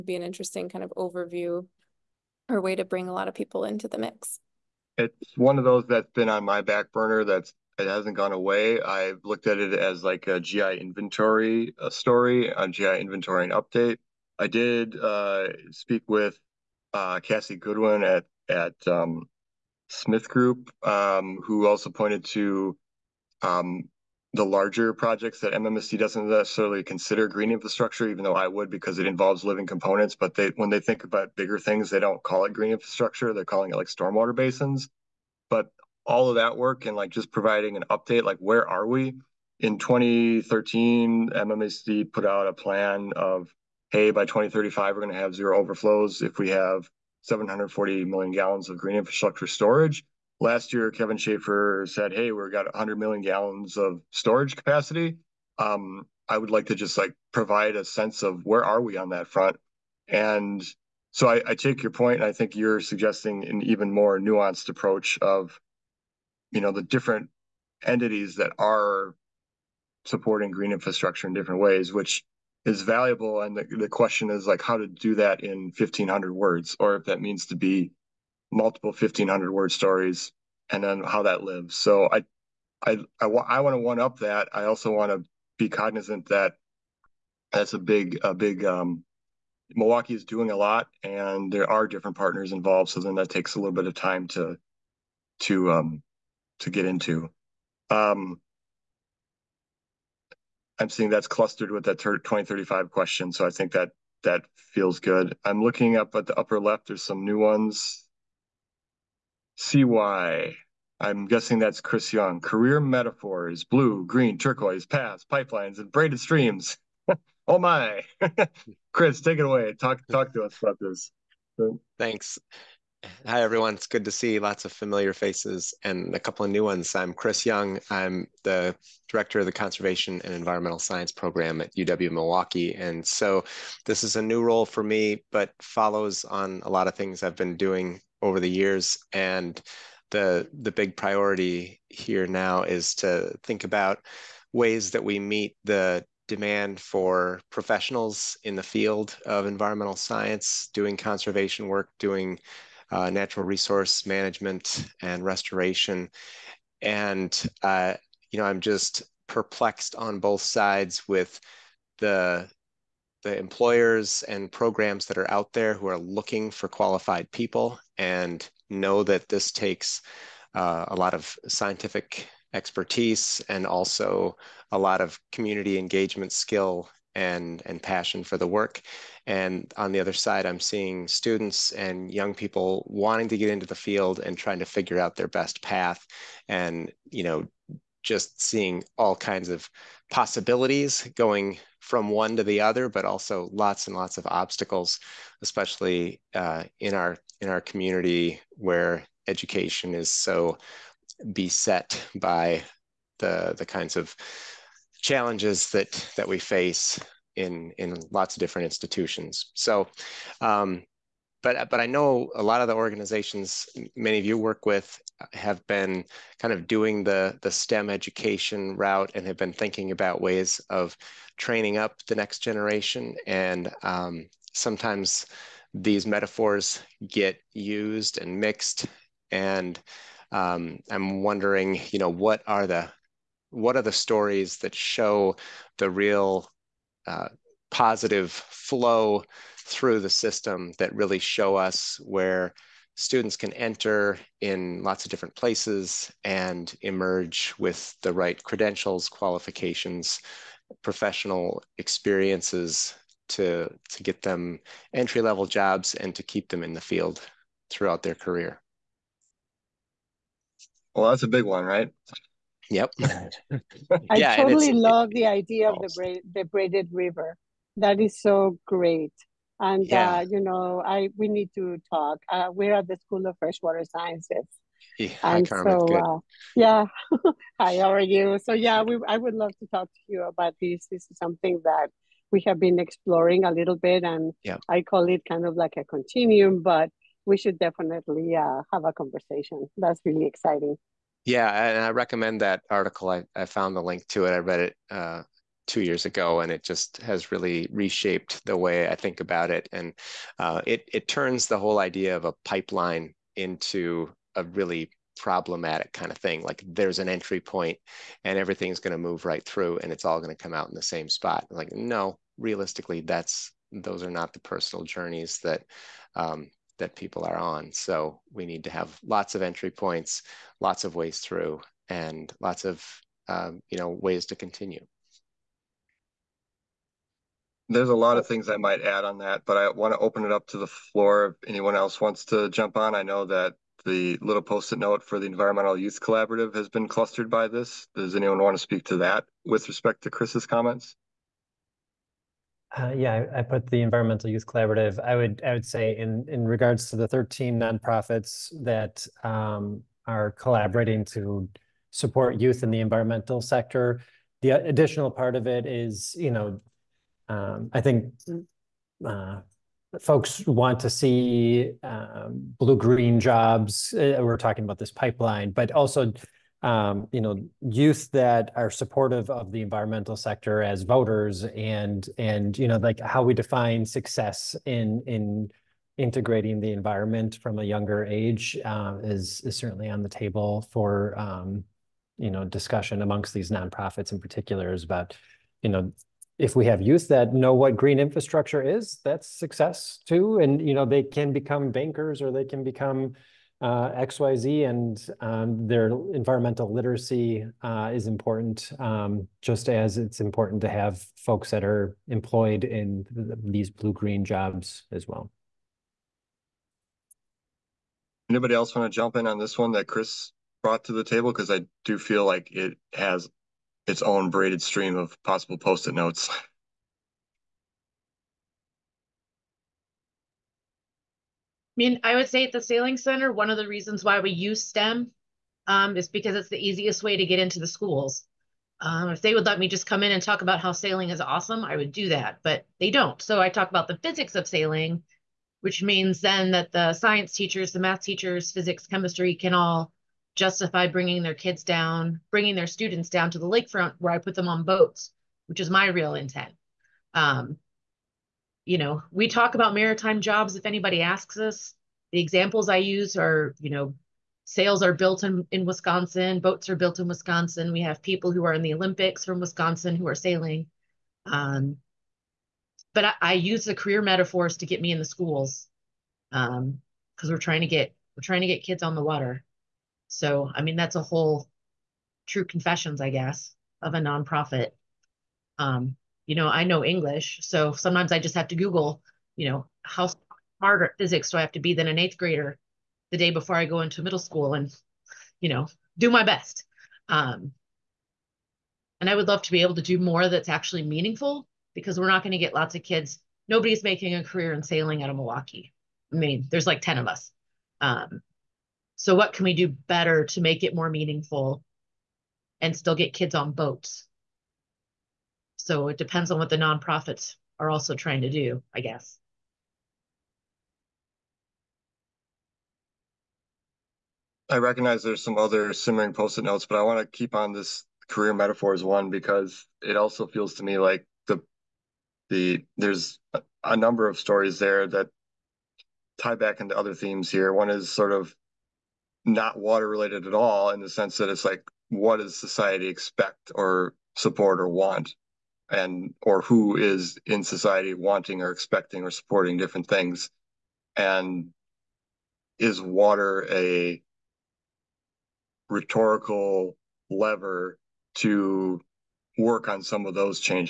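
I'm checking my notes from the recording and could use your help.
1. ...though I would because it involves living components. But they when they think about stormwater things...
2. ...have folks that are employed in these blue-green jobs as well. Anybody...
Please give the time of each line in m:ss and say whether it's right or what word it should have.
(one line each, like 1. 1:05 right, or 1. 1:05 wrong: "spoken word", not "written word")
1. 0:28 wrong: "bigger", not "stormwater"
2. 6:40 right.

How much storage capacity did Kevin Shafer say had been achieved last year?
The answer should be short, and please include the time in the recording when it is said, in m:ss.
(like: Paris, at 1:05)
100 million gallons, at 0:52.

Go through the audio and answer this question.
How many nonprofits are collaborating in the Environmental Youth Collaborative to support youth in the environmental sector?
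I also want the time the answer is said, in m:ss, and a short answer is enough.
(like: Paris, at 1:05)
13, at 5:47.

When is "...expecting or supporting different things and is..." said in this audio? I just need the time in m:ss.
8:58.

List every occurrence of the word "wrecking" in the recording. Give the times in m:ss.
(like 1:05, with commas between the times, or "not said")
not said.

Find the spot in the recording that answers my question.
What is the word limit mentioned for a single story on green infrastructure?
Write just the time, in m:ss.
1:15.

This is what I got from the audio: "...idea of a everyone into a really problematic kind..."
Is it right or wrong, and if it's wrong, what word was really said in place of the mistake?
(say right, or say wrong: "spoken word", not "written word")
wrong: "pipeline", not "everyone".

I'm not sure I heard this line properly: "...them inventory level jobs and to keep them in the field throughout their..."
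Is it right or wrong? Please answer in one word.
wrong.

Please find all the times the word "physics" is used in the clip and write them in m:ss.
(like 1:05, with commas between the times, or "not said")
7:14, 7:18, 8:00.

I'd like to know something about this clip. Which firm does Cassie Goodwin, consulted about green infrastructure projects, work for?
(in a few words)
SmithGroup.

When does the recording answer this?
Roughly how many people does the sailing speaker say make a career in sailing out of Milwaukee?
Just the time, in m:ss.
8:16.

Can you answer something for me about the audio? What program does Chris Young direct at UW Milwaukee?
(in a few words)
Conservation and Environmental Science Program.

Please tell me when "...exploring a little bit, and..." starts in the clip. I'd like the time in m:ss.
4:42.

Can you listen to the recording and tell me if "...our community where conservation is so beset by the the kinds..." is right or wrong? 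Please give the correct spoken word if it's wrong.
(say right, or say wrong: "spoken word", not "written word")
wrong: "education", not "conservation".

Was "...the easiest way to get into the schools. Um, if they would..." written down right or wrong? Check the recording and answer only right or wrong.
right.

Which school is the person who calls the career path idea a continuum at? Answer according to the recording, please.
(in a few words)
School of Freshwater Sciences.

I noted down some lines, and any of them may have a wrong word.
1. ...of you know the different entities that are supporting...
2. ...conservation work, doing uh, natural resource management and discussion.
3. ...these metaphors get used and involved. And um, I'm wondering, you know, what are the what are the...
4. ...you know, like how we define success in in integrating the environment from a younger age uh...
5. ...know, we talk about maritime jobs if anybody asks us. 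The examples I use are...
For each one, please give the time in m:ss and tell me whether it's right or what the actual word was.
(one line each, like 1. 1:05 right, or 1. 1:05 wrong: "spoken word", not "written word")
1. 1:05 right
2. 2:30 wrong: "restoration", not "discussion"
3. 3:45 wrong: "mixed", not "involved"
4. 6:12 right
5. 7:28 right.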